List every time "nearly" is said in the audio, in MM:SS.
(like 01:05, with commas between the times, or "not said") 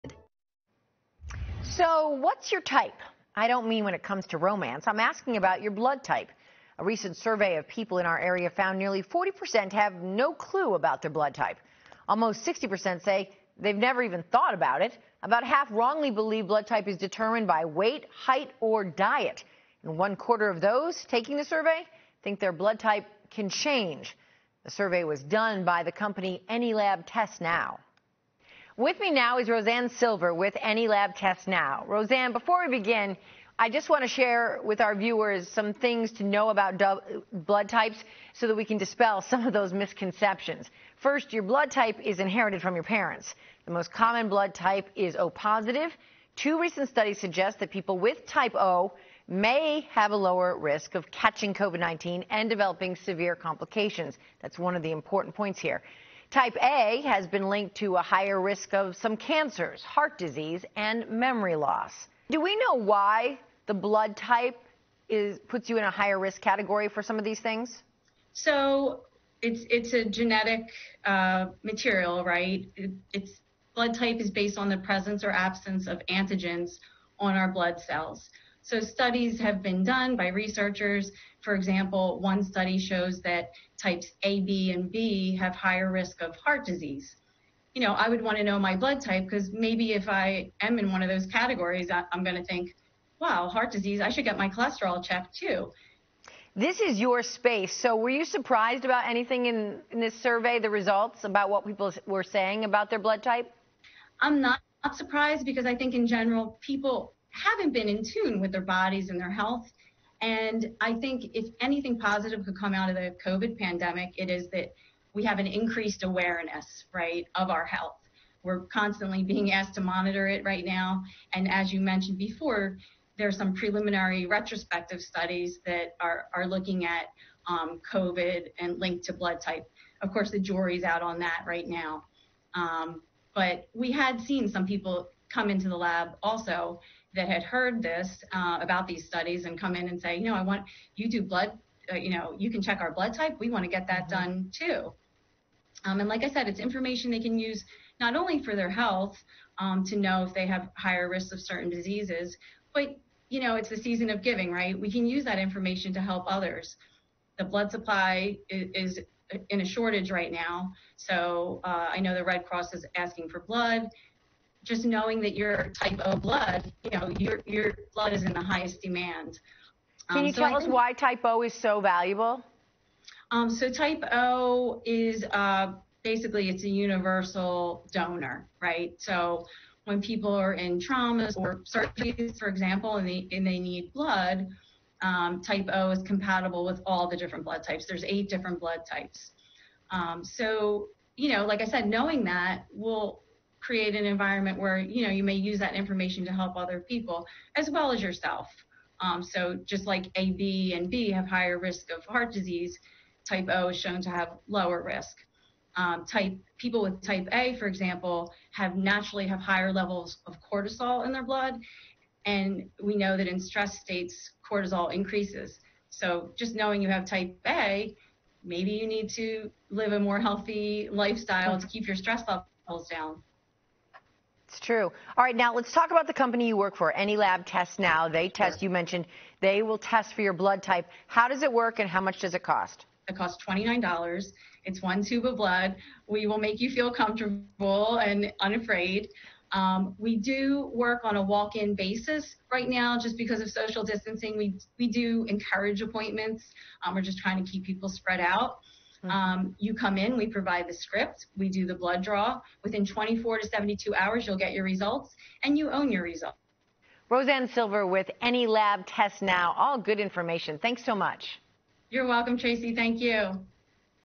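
00:08.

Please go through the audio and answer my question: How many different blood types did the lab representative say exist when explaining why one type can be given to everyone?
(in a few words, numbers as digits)
8.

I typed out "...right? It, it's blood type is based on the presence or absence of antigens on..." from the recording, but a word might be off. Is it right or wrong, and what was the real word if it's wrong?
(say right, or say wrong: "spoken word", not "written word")
right.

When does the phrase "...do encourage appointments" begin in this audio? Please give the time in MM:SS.
04:04.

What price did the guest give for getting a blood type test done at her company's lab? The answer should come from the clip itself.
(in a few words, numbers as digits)
$29.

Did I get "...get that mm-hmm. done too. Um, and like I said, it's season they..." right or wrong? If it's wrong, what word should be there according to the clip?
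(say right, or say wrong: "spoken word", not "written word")
wrong: "information", not "season".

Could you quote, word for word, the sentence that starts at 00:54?
That's one of the important points here.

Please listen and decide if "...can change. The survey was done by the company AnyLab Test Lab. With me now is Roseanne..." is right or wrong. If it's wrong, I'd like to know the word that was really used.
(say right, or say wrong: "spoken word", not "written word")
wrong: "Now", not "Lab".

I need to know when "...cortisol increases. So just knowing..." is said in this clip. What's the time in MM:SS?
03:34.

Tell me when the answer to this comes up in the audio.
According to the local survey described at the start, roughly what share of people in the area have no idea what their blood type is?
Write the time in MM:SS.
00:09.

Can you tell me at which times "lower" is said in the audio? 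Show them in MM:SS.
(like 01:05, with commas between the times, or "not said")
00:50, 03:24.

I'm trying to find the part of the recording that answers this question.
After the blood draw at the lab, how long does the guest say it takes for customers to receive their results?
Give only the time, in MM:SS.
04:12.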